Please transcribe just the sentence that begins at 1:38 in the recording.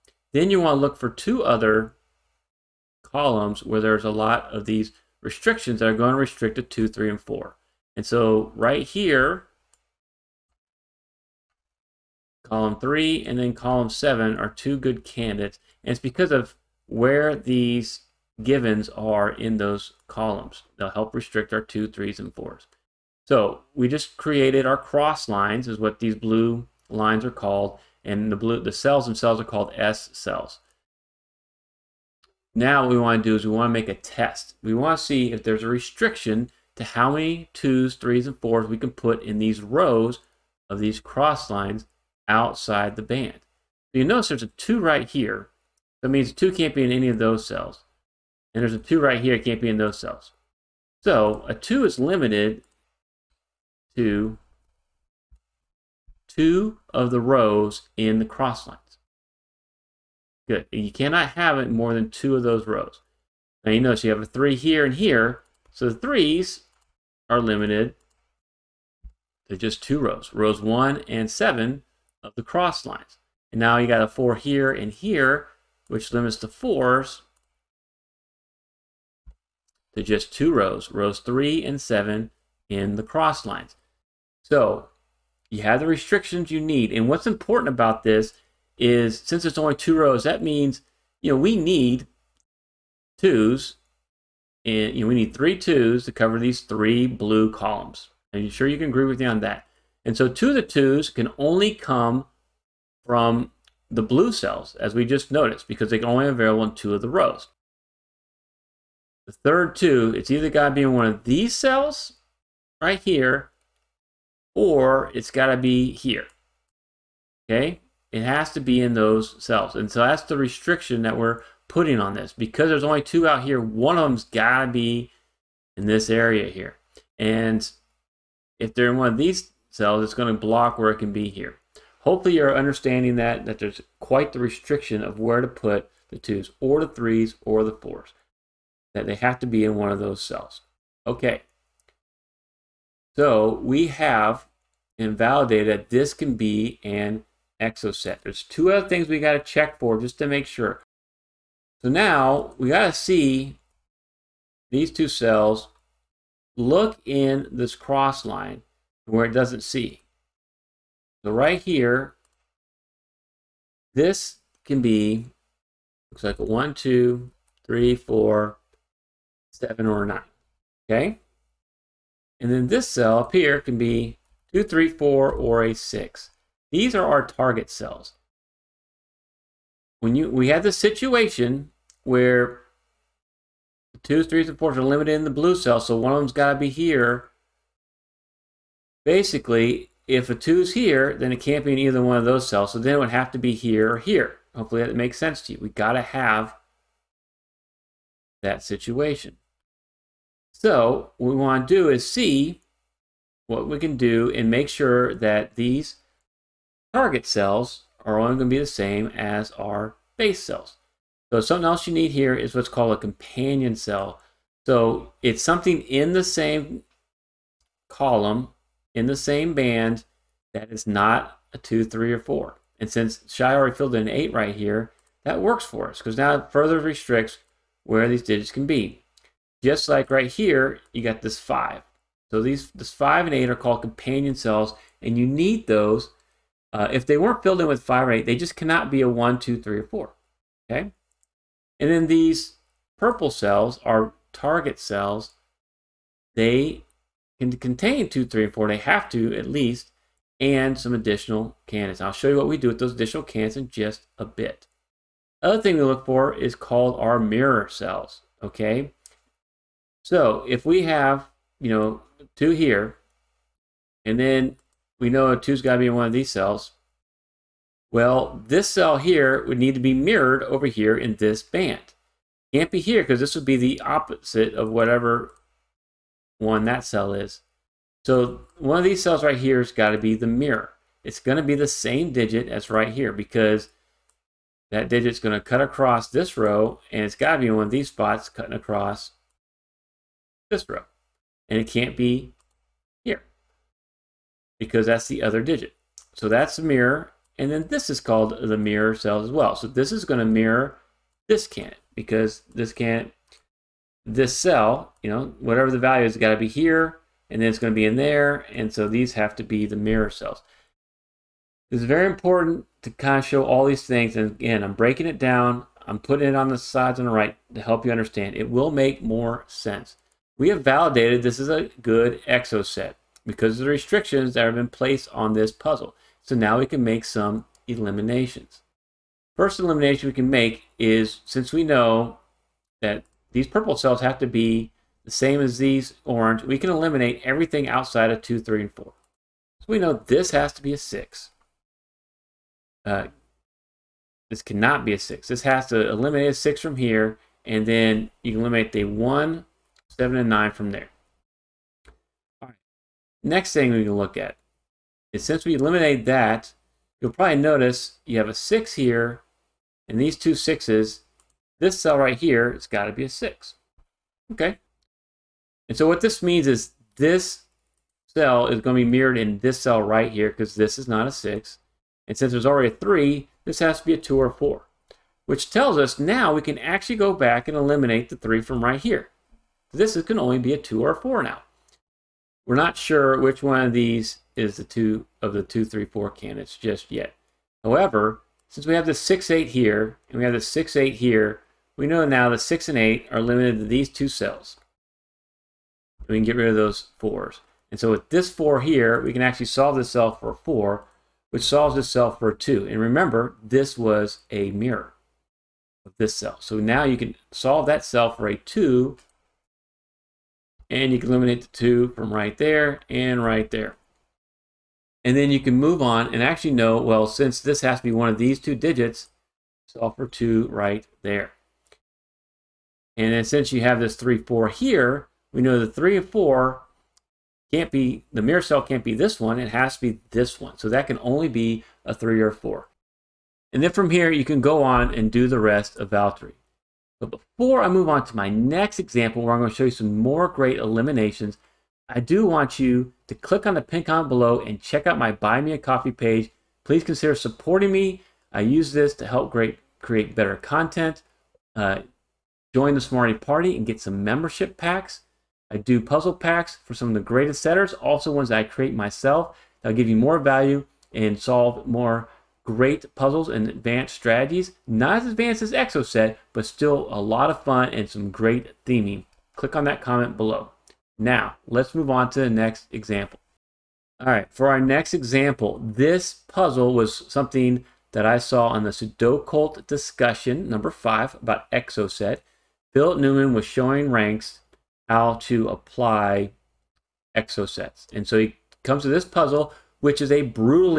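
Are you sure you can agree with me on that?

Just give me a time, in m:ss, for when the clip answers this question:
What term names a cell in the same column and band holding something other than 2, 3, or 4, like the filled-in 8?
3:32.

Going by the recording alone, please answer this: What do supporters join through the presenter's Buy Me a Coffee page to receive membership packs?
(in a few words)
the Smarty Party.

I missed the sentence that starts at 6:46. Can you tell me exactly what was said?
So now you can solve that cell for a 2, and you can eliminate the 2 from right there and right there.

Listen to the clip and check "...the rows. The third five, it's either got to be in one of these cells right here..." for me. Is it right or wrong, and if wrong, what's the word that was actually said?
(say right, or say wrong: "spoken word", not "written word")
wrong: "two", not "five".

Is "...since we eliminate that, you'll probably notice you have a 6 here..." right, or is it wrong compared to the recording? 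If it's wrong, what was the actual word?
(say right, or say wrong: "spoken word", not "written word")
right.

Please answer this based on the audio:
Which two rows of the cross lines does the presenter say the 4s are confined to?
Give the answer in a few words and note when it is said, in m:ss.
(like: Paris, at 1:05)
3 and 7, at 1:20.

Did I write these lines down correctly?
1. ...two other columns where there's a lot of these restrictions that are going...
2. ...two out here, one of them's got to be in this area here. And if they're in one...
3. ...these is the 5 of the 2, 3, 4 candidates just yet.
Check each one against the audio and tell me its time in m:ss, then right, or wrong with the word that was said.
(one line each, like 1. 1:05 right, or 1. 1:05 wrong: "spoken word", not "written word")
1. 0:01 right
2. 2:03 right
3. 6:23 wrong: "2", not "5".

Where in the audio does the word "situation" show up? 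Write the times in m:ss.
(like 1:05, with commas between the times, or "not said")
3:00, 3:18.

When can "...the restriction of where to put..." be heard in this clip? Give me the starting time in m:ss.
2:14.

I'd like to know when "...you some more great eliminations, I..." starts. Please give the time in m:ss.
7:19.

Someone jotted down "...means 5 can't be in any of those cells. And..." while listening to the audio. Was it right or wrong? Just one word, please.
wrong.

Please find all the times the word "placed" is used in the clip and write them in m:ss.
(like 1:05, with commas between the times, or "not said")
5:24.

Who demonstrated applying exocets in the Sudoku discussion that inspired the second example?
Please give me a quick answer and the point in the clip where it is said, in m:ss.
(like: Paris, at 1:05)
Philip Newman, at 8:02.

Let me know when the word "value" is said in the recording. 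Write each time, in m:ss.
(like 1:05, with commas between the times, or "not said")
5:05, 7:40.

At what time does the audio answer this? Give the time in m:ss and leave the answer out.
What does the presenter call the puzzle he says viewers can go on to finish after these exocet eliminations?
7:15.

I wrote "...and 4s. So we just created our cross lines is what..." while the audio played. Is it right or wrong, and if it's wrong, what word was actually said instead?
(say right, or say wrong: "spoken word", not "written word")
right.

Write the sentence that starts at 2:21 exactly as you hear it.
Okay, so we have invalidated that this can be an exocet.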